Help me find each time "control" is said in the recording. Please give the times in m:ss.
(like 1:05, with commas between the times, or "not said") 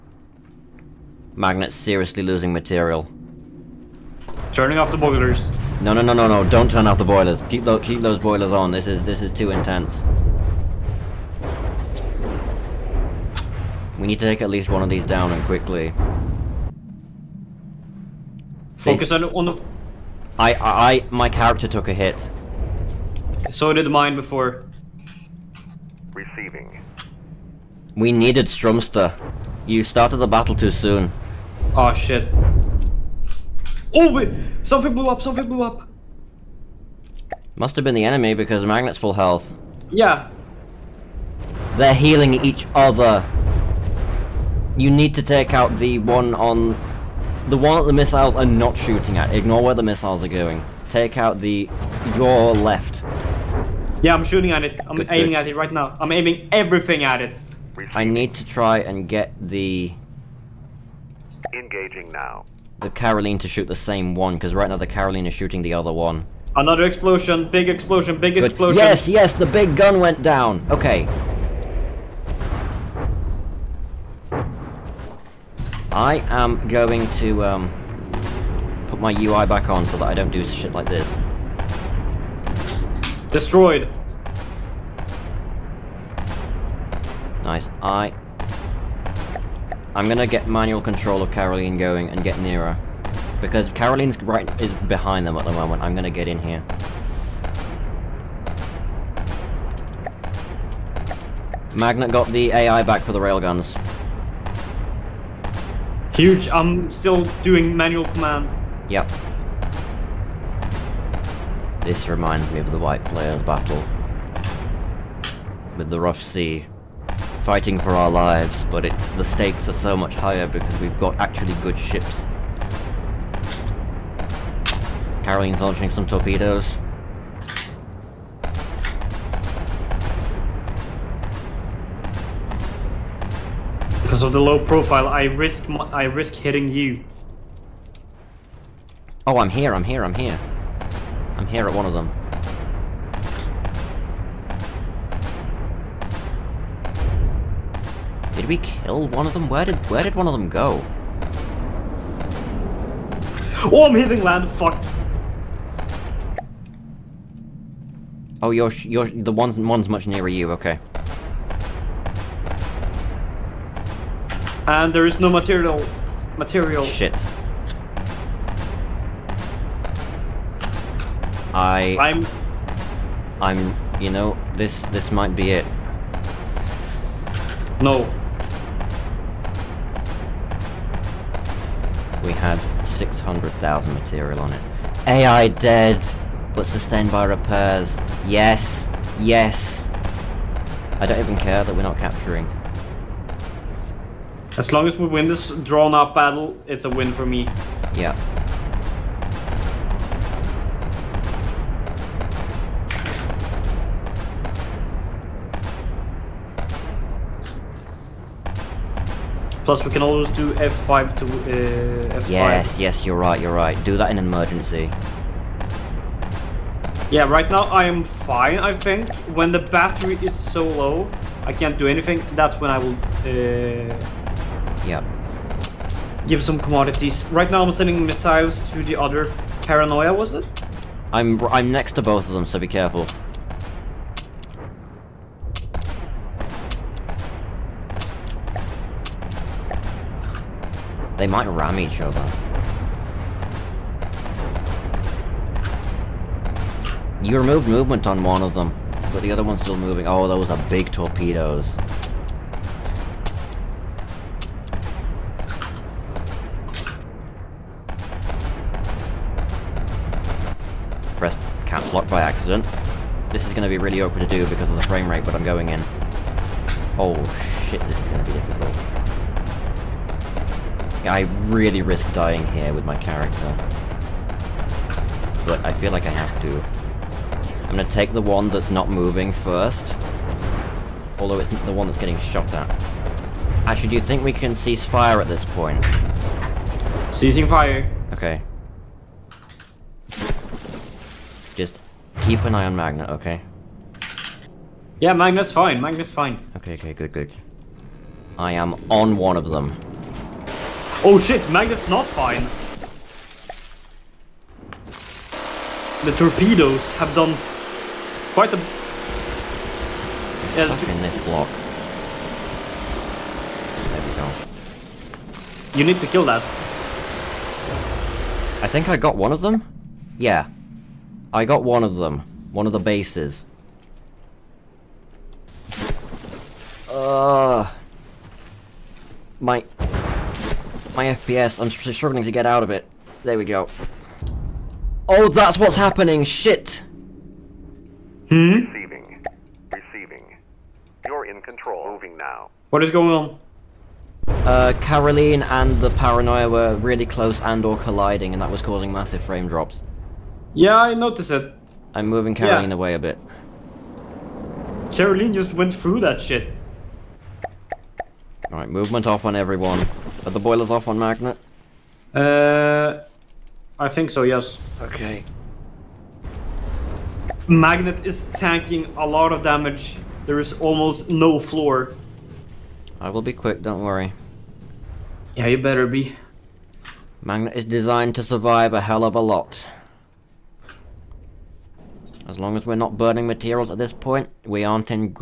1:30, 5:41.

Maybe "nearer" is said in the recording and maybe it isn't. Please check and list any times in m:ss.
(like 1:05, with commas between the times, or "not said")
1:32, 2:40.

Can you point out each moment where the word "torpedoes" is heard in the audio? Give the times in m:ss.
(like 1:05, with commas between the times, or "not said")
2:06, 4:10, 5:06.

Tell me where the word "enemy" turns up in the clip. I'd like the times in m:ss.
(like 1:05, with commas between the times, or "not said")
0:38.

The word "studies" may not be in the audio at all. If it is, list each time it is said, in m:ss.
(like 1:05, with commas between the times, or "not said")
not said.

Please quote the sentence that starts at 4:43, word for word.
Actually, do you think we can cease fire at this point?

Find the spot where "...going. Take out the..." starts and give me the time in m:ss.
0:50.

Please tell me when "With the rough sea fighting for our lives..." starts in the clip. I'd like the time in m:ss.
1:55.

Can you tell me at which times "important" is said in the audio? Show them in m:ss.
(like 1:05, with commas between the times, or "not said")
not said.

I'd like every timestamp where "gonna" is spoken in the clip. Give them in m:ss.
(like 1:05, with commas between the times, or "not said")
1:30, 1:35, 4:37.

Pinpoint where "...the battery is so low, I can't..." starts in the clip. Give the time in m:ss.
3:39.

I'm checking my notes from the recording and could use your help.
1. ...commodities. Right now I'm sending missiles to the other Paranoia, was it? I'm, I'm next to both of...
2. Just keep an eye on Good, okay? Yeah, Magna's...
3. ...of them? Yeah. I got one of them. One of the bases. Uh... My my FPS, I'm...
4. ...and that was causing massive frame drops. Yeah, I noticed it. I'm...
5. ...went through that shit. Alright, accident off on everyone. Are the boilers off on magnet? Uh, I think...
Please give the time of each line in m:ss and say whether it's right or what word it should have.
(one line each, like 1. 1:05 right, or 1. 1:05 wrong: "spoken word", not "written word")
1. 3:46 right
2. 4:51 wrong: "Magna", not "Good"
3. 5:19 right
4. 5:48 right
5. 5:55 wrong: "movement", not "accident".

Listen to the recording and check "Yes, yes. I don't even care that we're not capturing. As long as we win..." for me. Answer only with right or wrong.
right.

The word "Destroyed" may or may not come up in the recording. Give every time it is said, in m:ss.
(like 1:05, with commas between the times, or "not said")
1:23.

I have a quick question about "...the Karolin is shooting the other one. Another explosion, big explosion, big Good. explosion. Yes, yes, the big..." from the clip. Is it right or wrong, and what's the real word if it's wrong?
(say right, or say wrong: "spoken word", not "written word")
right.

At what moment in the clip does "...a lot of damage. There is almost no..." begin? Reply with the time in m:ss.
6:08.